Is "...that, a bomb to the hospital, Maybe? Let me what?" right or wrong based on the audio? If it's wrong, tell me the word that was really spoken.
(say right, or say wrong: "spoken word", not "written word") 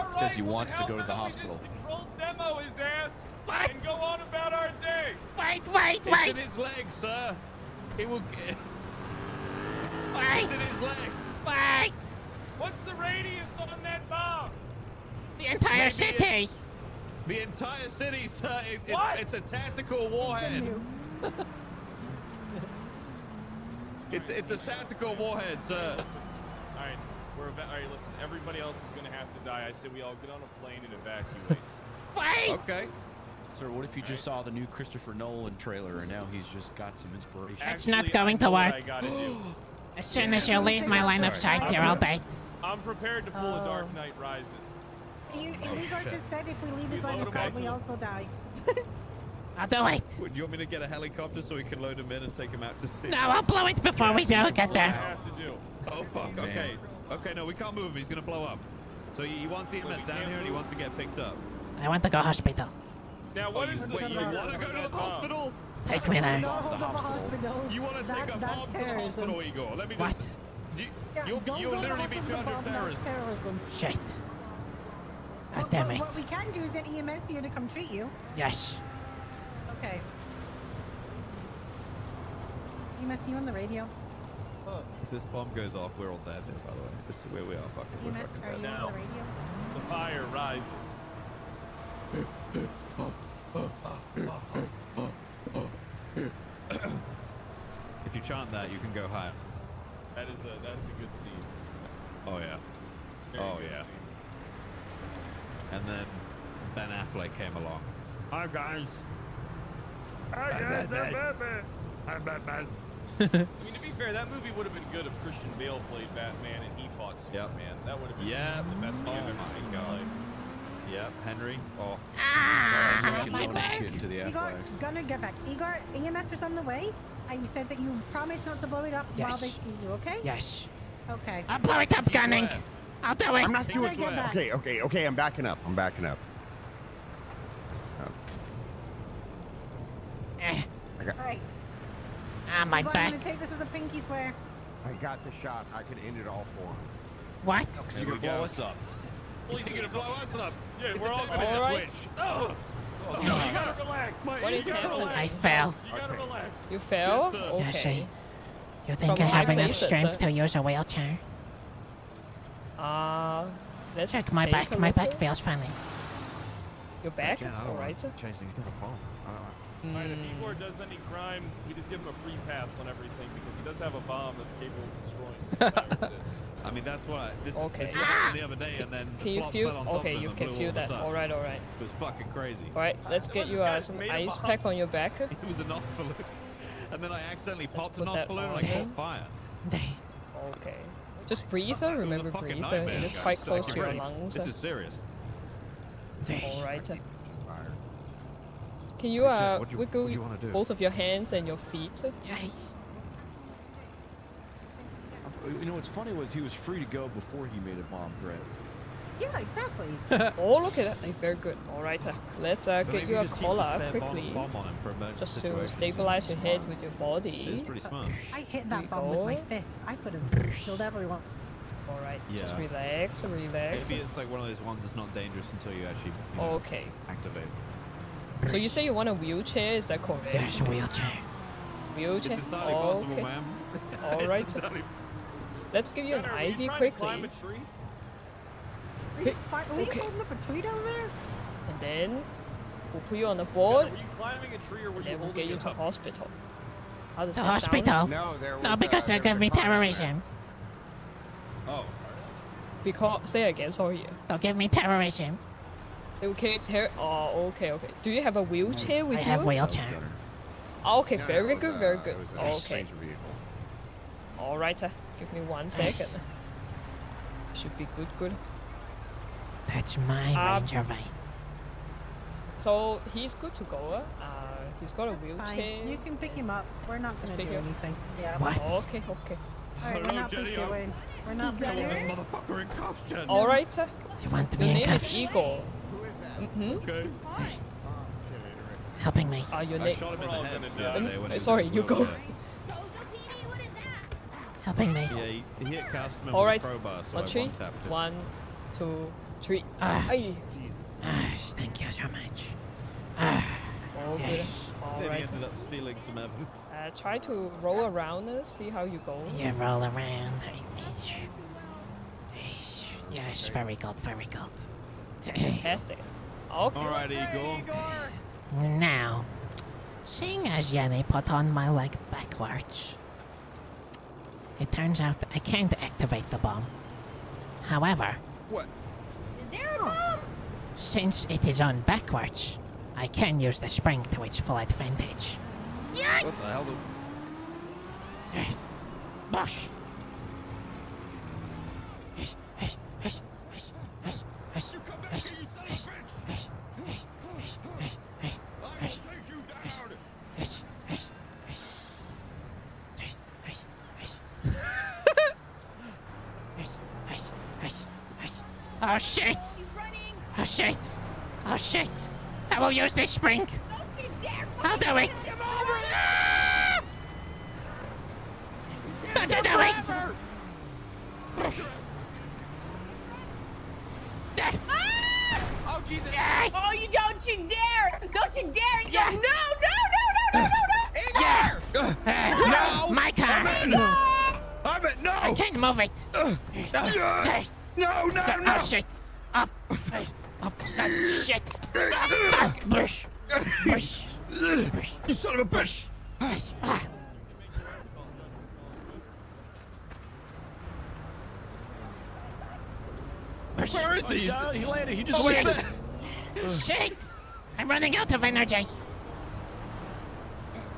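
wrong: "Igor", not "Maybe".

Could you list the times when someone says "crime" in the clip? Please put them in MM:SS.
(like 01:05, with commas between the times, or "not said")
02:51.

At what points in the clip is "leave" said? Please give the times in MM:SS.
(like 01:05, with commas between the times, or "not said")
00:40, 00:46.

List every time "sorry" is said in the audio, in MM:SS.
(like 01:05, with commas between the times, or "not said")
04:13, 04:51.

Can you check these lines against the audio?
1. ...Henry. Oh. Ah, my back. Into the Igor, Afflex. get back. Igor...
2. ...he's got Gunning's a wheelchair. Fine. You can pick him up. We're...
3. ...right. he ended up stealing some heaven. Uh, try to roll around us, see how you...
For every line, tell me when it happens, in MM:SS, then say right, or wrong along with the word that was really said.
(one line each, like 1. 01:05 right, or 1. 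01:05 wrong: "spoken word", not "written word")
1. 02:01 right
2. 04:34 wrong: "That", not "Gunning"
3. 05:05 right.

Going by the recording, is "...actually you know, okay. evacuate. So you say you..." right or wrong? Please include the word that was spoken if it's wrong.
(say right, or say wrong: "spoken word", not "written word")
wrong: "activate", not "evacuate".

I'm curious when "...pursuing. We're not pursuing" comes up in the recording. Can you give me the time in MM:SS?
04:40.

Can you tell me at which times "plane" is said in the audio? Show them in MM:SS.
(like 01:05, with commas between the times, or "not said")
00:30.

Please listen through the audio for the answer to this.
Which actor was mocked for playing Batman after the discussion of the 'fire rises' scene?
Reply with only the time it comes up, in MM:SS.
01:46.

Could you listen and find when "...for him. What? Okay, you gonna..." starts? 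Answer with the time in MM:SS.
02:26.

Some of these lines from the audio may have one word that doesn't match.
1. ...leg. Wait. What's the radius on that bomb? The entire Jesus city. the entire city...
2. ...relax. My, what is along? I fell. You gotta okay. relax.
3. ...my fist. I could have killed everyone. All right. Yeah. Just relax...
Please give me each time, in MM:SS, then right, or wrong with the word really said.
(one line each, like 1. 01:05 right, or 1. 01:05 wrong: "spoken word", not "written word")
1. 00:10 wrong: "Maybe", not "Jesus"
2. 02:33 wrong: "happening", not "along"
3. 03:39 right.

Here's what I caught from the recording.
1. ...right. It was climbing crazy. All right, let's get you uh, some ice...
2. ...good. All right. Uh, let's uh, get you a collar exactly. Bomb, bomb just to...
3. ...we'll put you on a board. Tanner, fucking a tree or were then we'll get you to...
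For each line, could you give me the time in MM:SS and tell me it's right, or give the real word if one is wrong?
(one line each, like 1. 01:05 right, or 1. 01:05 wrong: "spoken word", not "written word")
1. 03:01 wrong: "fucking", not "climbing"
2. 03:31 wrong: "quickly", not "exactly"
3. 04:02 wrong: "climbing", not "fucking".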